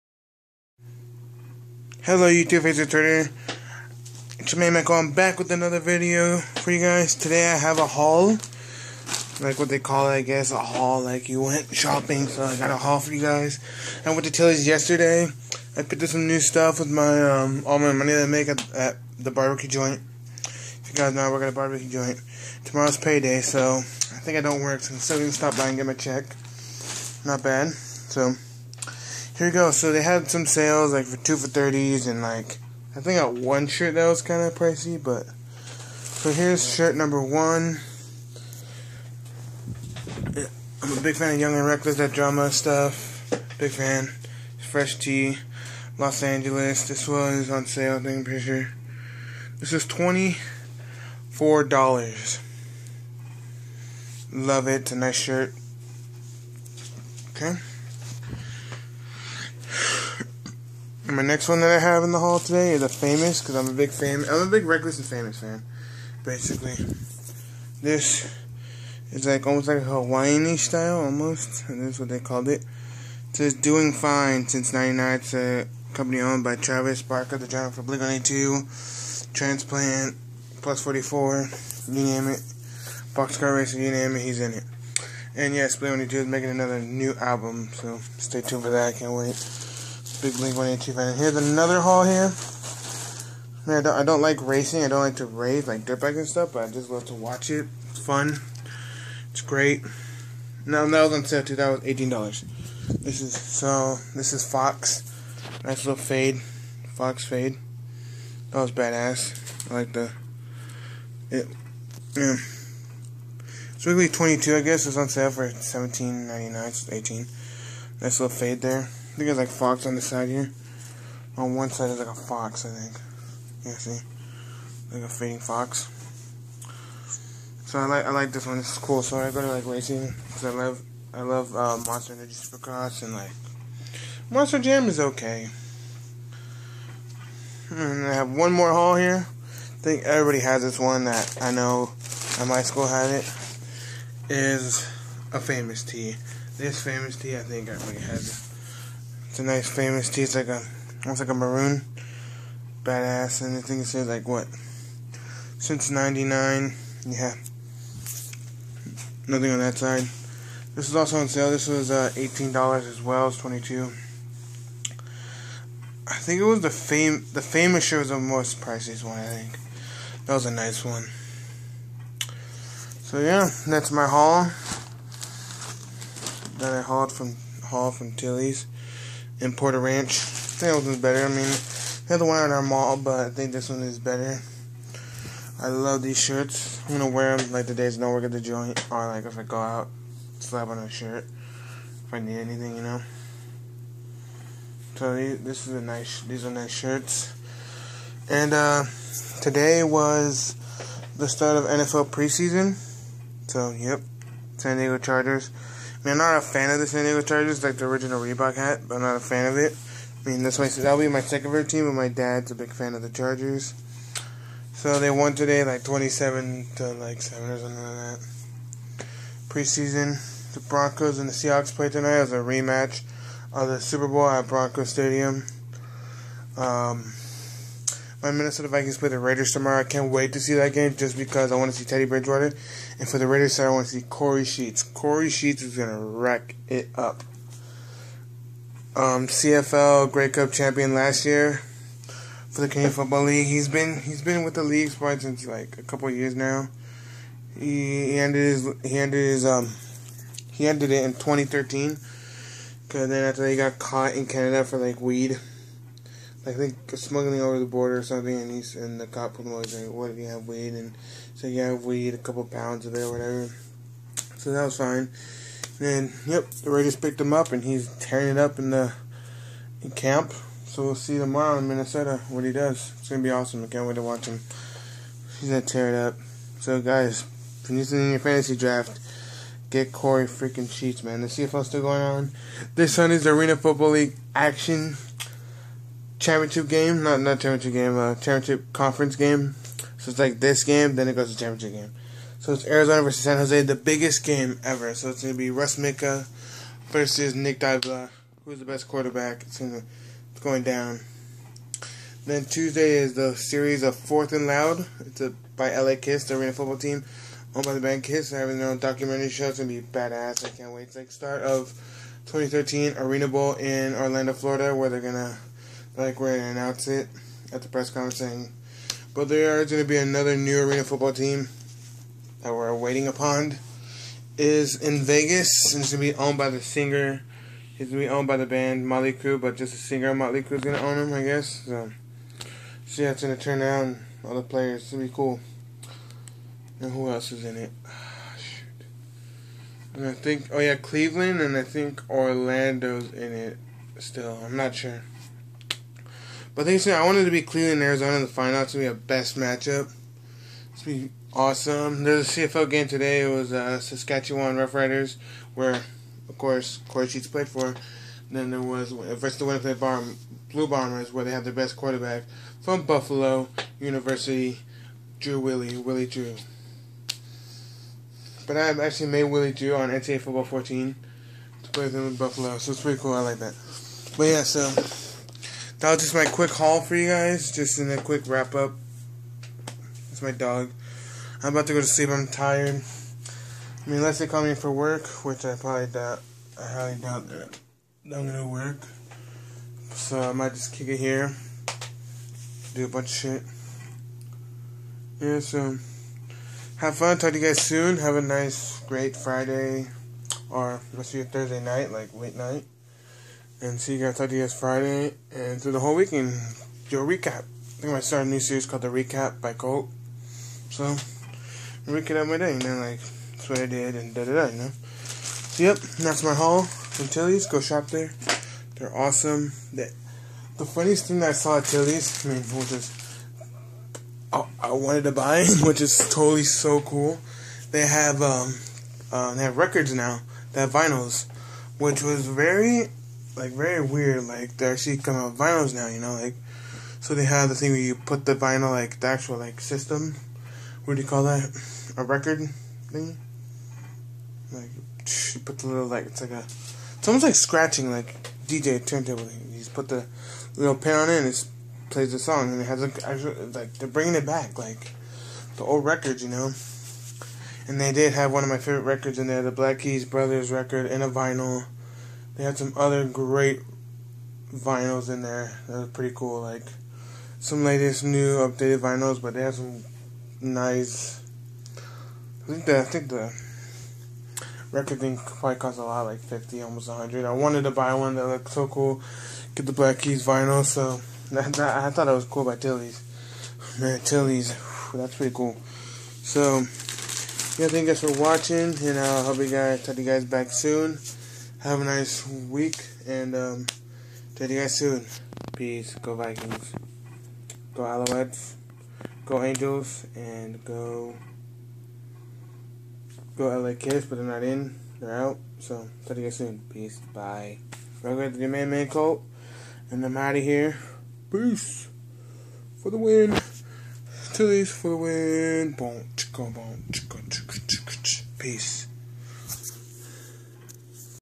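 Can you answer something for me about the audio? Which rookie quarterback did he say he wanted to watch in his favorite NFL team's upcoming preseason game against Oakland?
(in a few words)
Teddy Bridgewater.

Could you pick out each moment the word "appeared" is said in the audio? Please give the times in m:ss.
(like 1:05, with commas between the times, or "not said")
not said.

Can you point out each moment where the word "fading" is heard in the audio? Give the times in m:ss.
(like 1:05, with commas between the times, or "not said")
2:05.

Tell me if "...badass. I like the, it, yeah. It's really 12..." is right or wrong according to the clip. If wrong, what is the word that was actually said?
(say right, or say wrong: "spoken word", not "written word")
wrong: "22", not "12".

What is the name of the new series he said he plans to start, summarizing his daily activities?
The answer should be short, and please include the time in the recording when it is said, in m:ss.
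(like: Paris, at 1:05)
The Recap by Colt, at 6:48.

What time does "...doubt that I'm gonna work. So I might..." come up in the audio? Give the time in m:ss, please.
6:26.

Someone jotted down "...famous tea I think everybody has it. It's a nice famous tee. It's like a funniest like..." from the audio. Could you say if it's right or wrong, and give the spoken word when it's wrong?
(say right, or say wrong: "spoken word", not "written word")
wrong: "almost", not "funniest".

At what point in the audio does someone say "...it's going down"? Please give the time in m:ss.
5:00.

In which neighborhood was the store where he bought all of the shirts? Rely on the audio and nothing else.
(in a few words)
Porter Ranch.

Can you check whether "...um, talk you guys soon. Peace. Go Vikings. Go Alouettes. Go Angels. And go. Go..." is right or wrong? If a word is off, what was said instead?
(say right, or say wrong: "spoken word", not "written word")
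right.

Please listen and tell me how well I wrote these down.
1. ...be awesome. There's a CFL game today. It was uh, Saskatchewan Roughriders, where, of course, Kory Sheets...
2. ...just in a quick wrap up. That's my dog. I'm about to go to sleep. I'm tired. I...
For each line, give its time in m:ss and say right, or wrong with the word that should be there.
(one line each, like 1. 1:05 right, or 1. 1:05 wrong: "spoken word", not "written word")
1. 5:50 right
2. 6:17 right.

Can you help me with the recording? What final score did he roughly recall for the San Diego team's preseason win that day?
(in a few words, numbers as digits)
27 to 7.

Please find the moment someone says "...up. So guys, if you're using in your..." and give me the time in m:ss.
4:35.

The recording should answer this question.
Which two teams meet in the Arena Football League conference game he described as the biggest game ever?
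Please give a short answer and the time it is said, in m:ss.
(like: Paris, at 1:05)
Arizona versus San Jose, at 4:52.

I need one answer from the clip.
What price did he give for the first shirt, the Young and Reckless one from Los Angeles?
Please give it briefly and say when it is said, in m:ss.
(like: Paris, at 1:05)
$24, at 0:49.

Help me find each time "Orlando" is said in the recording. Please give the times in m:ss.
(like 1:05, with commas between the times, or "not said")
5:13, 5:42.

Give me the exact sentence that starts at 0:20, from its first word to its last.
If you guys know, I work at a barbecue joint.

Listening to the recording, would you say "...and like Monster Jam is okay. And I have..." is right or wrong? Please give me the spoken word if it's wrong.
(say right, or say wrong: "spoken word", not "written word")
right.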